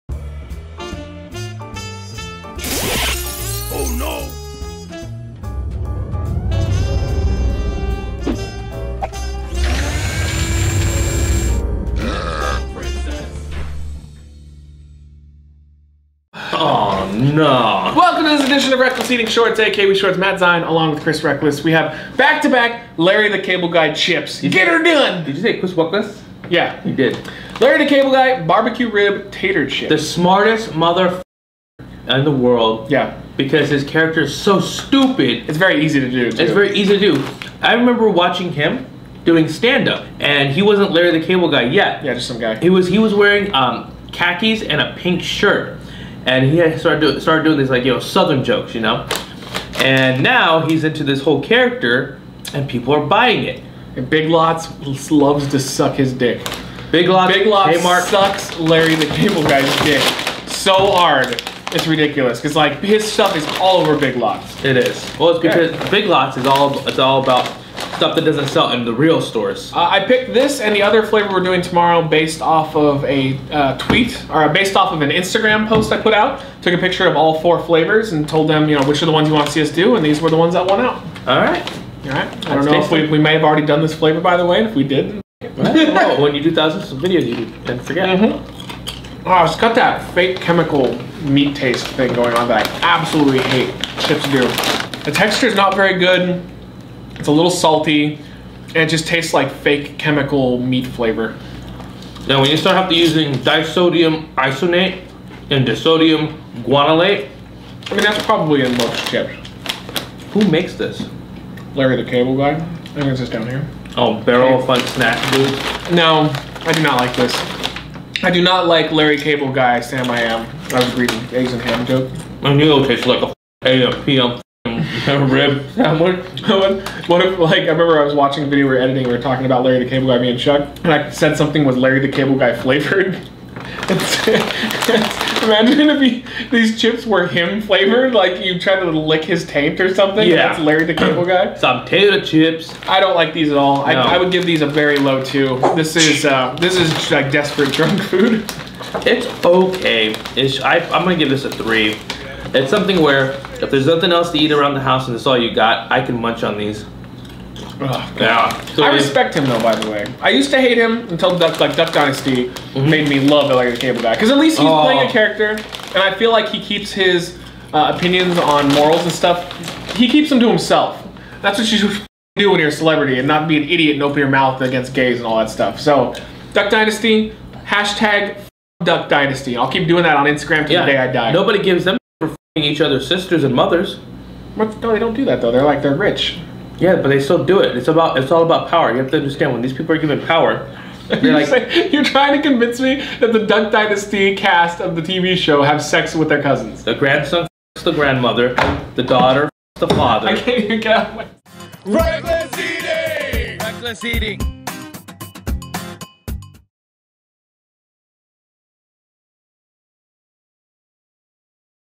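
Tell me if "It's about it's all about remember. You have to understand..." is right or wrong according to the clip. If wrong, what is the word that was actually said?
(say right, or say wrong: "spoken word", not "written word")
wrong: "power", not "remember".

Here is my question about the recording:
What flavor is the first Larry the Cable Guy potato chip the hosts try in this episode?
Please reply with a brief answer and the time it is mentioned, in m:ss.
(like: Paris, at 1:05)
Barbecue rib, at 0:28.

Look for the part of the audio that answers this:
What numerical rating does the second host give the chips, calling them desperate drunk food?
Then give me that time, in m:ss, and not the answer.
2:31.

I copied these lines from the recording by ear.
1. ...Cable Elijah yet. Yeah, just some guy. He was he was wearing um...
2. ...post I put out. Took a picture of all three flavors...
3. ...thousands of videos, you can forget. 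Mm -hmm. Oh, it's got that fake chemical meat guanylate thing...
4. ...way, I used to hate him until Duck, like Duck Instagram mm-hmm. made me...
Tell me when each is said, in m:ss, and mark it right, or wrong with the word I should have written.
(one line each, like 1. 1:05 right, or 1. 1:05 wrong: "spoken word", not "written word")
1. 0:41 wrong: "Guy", not "Elijah"
2. 1:15 wrong: "four", not "three"
3. 1:26 wrong: "taste", not "guanylate"
4. 2:39 wrong: "Dynasty", not "Instagram".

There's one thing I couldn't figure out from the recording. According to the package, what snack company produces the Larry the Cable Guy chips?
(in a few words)
Barrel of Fun.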